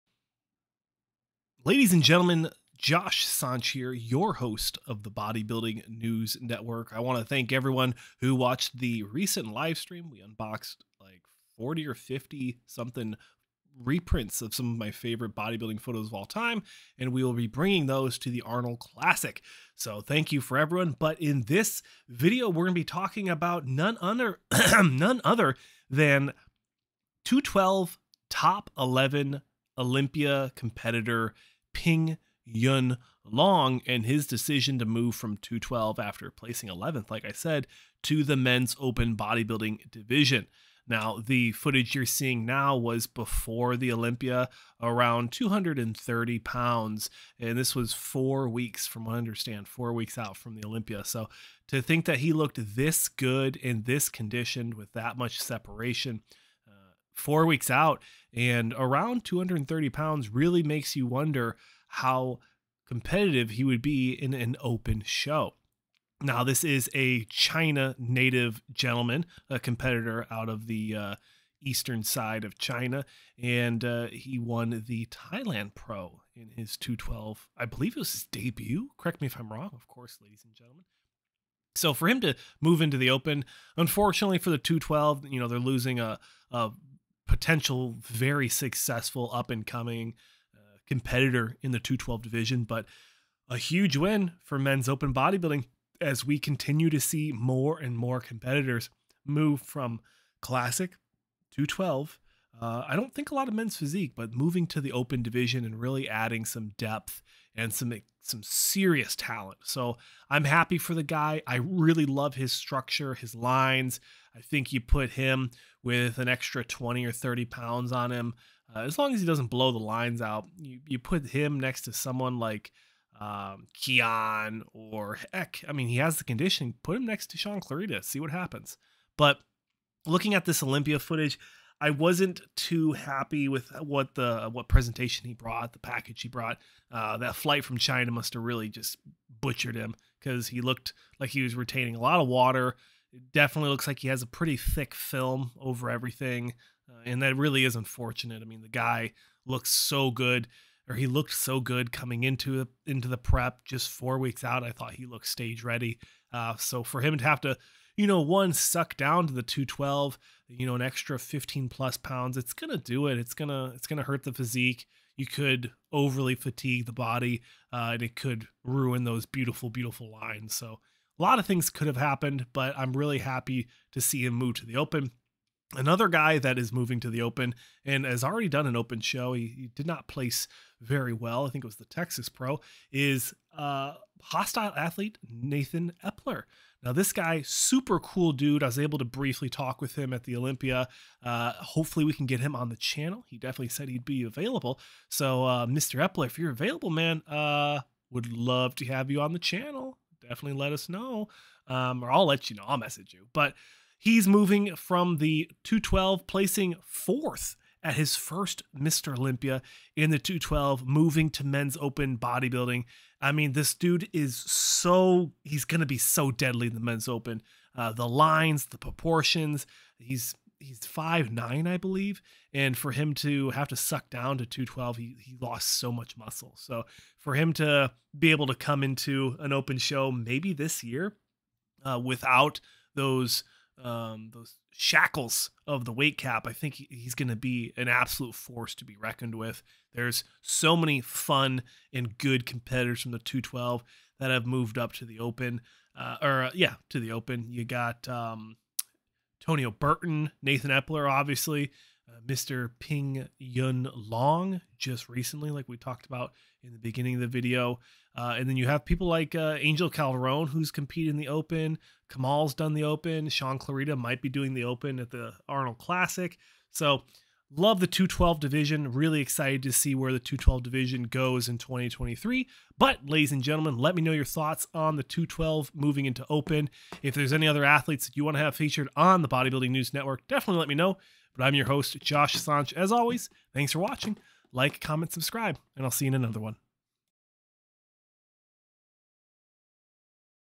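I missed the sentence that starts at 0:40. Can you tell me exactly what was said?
Now, the footage you're seeing now was before the Olympia, around 230 pounds.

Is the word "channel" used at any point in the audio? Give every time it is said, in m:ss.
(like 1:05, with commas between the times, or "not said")
3:12, 3:19.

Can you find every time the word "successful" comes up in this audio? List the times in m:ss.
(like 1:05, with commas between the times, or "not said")
1:28.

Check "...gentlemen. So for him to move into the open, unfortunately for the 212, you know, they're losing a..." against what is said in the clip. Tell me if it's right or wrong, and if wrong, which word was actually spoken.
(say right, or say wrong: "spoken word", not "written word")
right.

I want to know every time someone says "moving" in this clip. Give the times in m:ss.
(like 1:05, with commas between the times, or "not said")
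1:44, 2:56, 3:24, 3:30, 4:35.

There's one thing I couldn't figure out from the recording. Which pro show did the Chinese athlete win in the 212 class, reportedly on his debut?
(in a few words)
Thailand Pro.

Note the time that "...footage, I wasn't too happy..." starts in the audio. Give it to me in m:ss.
2:10.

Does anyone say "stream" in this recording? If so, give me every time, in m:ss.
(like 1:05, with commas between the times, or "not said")
0:09.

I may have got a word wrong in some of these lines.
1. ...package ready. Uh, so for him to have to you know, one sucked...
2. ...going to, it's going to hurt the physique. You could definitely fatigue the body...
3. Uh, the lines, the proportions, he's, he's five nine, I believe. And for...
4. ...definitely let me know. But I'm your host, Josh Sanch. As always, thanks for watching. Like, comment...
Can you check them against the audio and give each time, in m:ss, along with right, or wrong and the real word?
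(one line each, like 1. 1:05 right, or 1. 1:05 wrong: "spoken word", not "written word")
1. 2:35 wrong: "stage", not "package"
2. 2:43 wrong: "overly", not "definitely"
3. 3:37 right
4. 4:40 right.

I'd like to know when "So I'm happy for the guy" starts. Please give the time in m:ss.
1:49.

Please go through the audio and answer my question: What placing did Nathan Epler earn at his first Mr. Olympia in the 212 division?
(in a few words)
fourth.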